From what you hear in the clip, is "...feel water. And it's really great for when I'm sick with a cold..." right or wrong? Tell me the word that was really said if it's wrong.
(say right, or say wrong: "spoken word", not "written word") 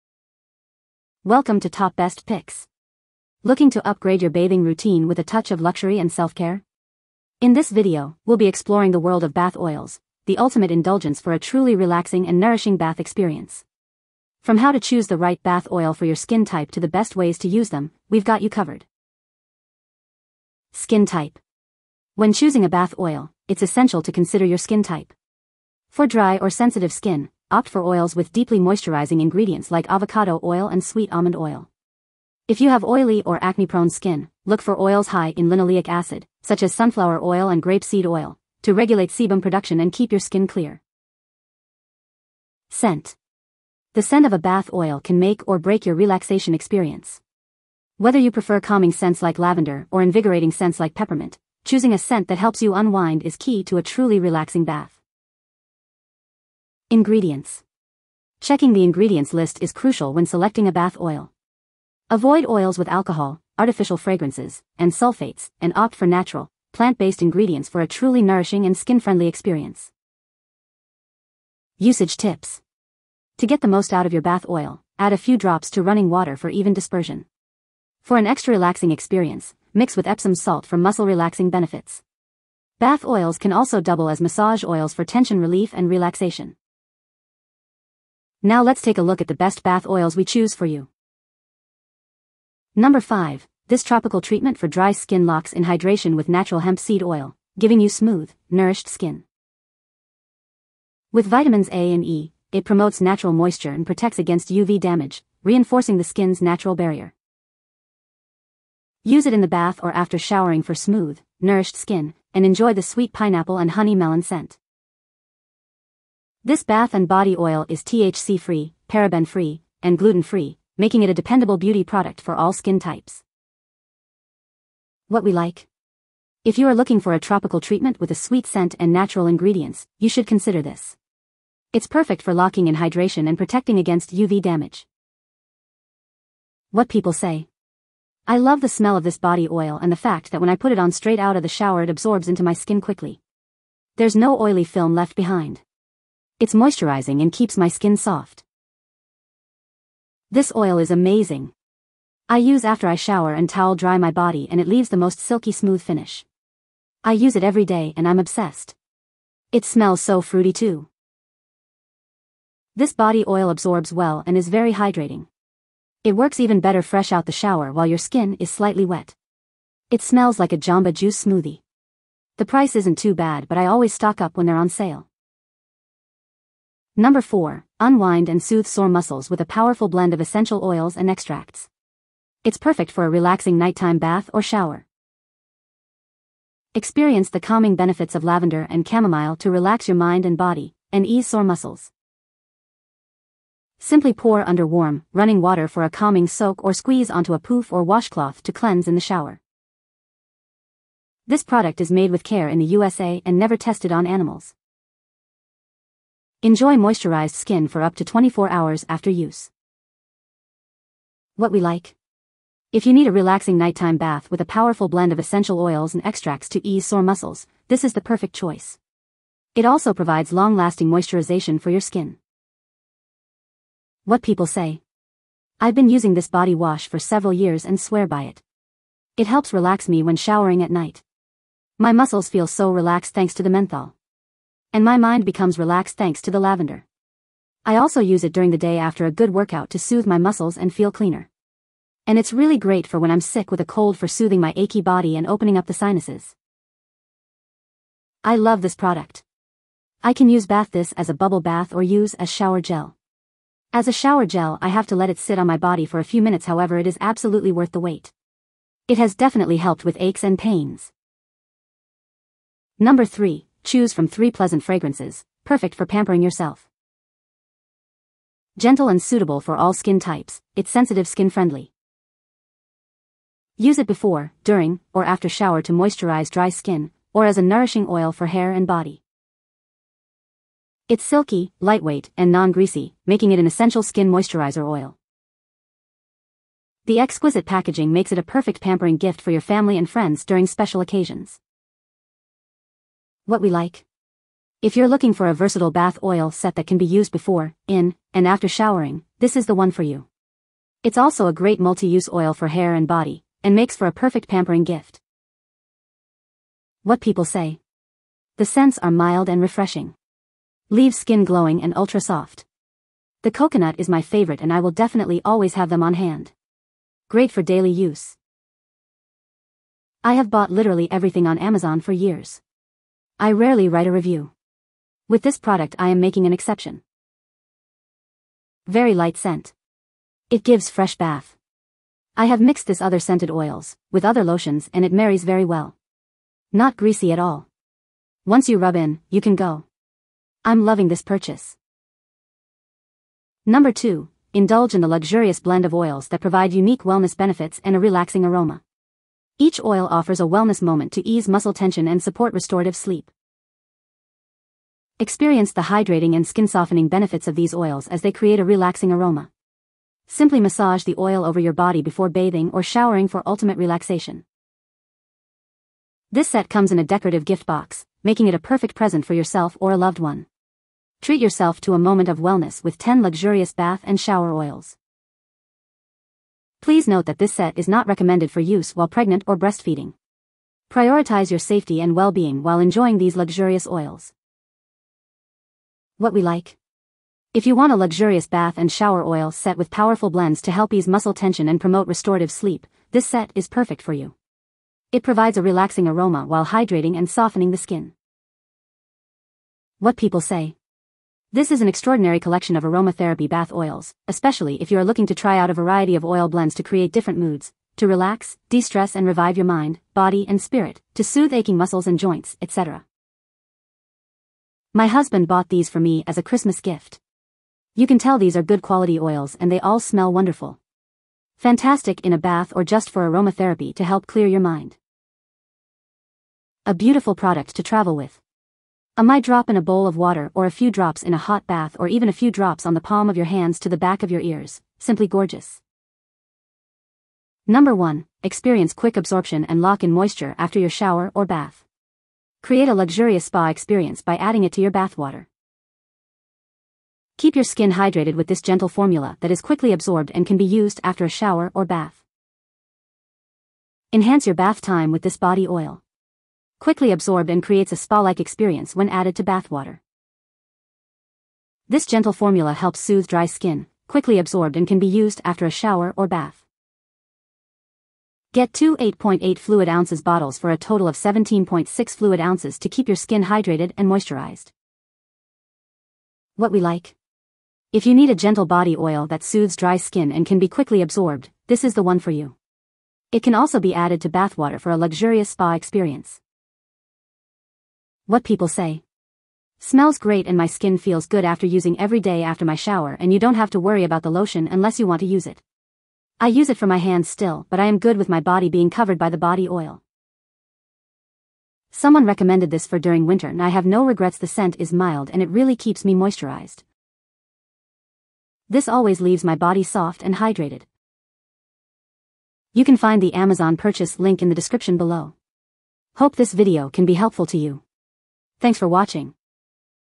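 wrong: "cleaner", not "water".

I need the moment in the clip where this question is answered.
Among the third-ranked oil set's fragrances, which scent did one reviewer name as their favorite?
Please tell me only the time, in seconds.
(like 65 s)
313 s.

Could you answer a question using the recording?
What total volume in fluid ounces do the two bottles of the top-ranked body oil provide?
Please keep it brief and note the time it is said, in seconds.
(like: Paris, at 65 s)
17.6 fluid ounces, at 470 s.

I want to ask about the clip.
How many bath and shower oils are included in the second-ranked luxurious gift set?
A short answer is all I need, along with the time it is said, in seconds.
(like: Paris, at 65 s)
10, at 372 s.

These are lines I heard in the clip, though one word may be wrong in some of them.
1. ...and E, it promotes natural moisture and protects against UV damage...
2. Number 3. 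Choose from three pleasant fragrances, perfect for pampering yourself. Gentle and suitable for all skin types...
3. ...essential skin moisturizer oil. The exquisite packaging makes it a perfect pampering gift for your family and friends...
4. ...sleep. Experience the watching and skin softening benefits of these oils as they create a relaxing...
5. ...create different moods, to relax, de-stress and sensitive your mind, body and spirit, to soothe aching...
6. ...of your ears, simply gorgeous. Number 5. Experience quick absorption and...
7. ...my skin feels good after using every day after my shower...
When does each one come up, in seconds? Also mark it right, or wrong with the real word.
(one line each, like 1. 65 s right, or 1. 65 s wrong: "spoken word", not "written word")
1. 101 s right
2. 262 s right
3. 283 s right
4. 352 s wrong: "hydrating", not "watching"
5. 406 s wrong: "revive", not "sensitive"
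6. 434 s wrong: "1", not "5"
7. 490 s right.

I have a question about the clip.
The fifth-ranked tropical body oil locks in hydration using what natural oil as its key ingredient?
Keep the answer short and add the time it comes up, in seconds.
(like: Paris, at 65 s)
hemp seed oil, at 96 s.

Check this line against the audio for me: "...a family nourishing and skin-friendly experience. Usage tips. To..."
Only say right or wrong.
wrong.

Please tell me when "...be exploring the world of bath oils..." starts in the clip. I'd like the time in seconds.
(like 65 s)
8 s.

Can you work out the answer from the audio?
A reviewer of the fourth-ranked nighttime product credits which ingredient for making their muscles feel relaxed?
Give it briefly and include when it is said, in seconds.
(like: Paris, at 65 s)
menthol, at 233 s.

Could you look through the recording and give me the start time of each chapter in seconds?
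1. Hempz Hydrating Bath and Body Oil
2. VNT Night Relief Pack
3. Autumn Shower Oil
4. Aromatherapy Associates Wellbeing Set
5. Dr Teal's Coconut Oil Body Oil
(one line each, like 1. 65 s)
1. 91 s
2. 175 s
3. 261 s
4. 342 s
5. 436 s.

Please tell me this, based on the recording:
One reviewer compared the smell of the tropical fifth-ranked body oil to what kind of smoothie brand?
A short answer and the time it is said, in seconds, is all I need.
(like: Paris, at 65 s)
Jamba Juice, at 170 s.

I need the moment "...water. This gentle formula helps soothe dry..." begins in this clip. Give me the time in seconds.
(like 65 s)
459 s.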